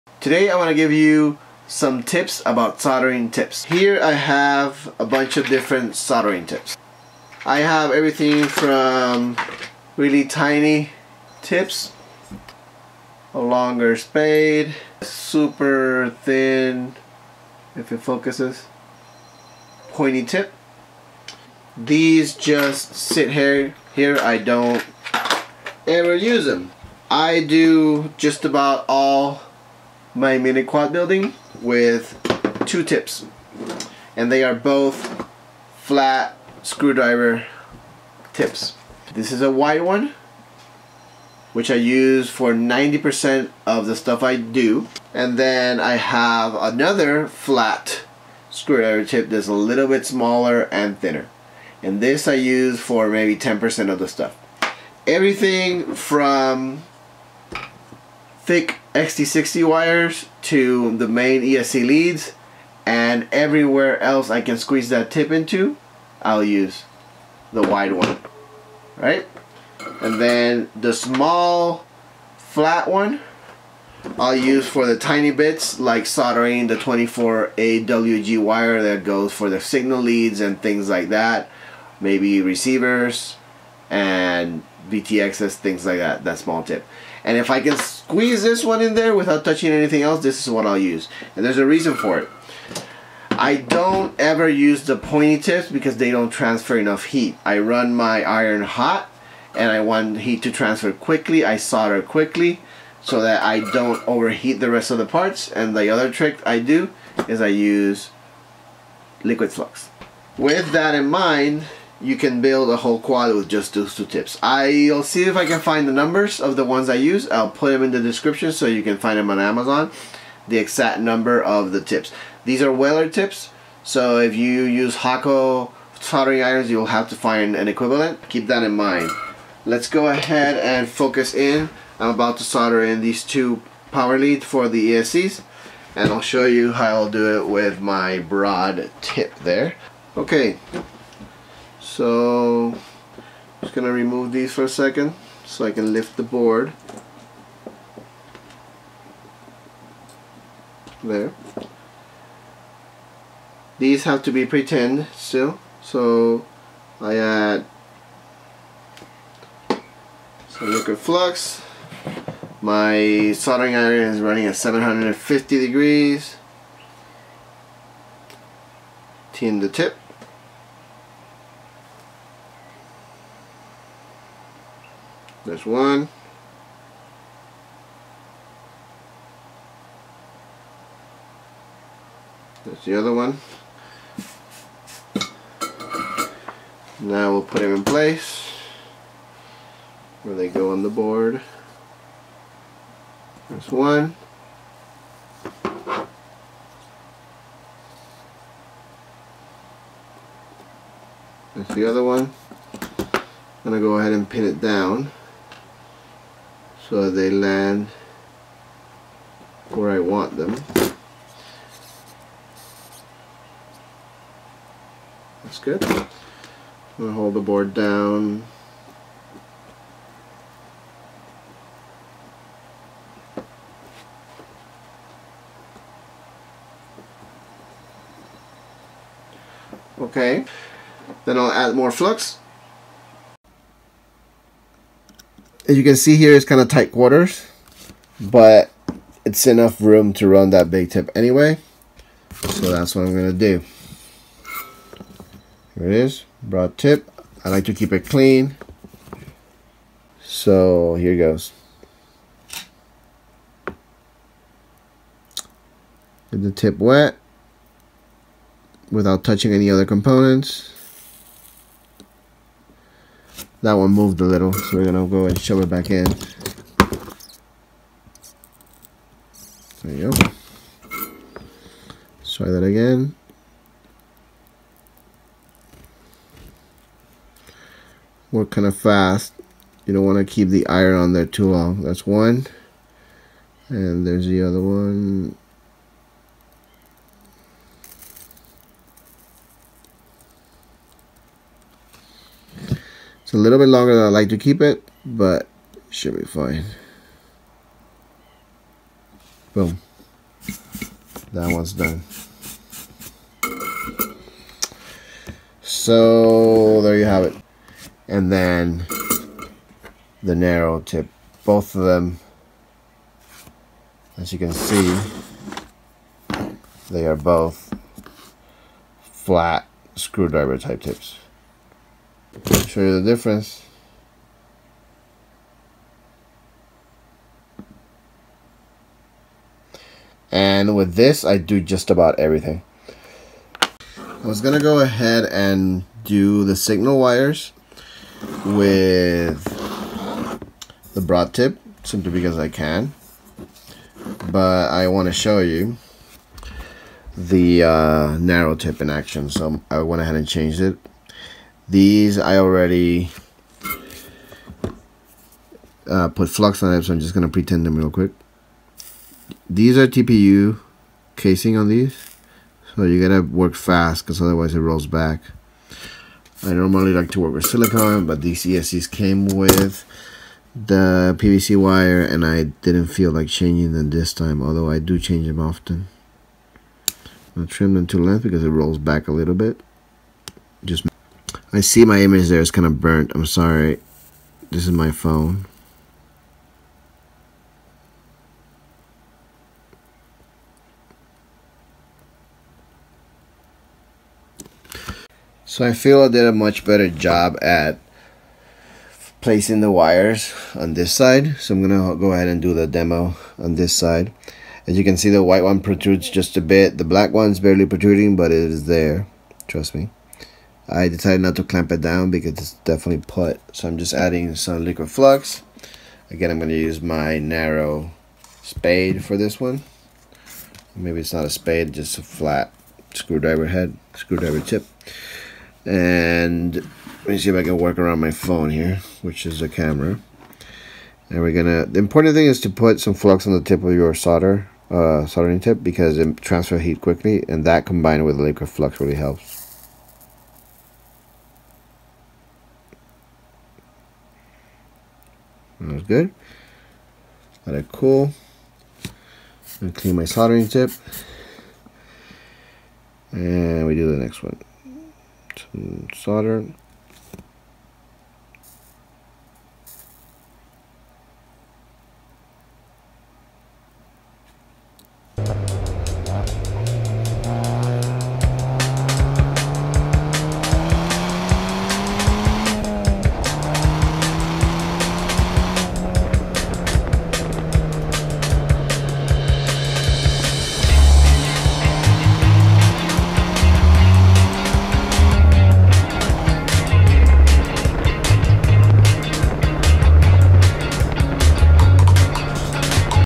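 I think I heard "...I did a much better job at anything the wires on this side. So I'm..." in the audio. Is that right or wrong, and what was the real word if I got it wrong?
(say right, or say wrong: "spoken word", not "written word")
wrong: "placing", not "anything".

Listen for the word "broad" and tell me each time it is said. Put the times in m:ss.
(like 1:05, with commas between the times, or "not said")
2:18, 4:06, 5:41.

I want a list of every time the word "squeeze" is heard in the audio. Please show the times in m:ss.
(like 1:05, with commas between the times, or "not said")
1:04, 1:27.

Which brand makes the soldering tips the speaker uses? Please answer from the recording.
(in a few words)
Weller.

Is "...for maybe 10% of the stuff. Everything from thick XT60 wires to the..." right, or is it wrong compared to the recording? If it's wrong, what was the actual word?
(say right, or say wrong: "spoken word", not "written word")
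right.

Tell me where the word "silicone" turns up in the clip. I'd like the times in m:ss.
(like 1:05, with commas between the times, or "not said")
6:07.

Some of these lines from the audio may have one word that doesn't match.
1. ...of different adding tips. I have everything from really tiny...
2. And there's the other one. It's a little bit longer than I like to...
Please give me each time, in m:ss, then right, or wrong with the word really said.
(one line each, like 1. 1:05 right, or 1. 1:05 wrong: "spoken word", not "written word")
1. 0:05 wrong: "soldering", not "adding"
2. 4:43 right.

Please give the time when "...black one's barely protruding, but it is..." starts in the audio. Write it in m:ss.
6:46.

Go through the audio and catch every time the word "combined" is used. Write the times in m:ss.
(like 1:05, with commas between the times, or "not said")
7:17.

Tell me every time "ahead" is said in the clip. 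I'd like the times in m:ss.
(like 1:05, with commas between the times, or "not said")
2:10, 3:23, 5:34, 5:50, 6:42.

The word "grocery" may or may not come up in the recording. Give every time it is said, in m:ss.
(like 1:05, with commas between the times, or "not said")
not said.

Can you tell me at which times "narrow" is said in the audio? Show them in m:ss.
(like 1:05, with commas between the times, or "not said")
5:10, 5:48, 6:57.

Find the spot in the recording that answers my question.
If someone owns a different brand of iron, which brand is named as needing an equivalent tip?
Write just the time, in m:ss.
2:04.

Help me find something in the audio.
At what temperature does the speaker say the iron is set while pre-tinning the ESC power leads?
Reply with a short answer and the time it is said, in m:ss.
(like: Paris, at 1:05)
750 degrees, at 2:44.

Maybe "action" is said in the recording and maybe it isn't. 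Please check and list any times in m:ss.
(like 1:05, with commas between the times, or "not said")
5:48.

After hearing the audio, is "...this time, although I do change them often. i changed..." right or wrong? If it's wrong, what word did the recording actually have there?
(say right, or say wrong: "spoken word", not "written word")
wrong: "trimmed", not "changed".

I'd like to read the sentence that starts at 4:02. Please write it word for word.
So that's what I'm going to do.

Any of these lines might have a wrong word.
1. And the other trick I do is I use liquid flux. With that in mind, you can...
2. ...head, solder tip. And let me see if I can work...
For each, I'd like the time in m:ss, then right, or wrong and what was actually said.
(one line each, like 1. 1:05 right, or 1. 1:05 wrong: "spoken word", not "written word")
1. 1:45 right
2. 7:03 wrong: "screwdriver", not "solder".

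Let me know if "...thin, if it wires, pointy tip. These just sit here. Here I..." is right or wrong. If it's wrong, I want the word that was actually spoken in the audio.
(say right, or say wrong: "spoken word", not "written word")
wrong: "focuses", not "wires".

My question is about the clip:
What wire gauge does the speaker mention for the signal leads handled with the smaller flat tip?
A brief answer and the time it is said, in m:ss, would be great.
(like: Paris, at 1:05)
24AWG, at 1:16.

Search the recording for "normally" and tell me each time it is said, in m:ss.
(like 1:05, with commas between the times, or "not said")
6:06.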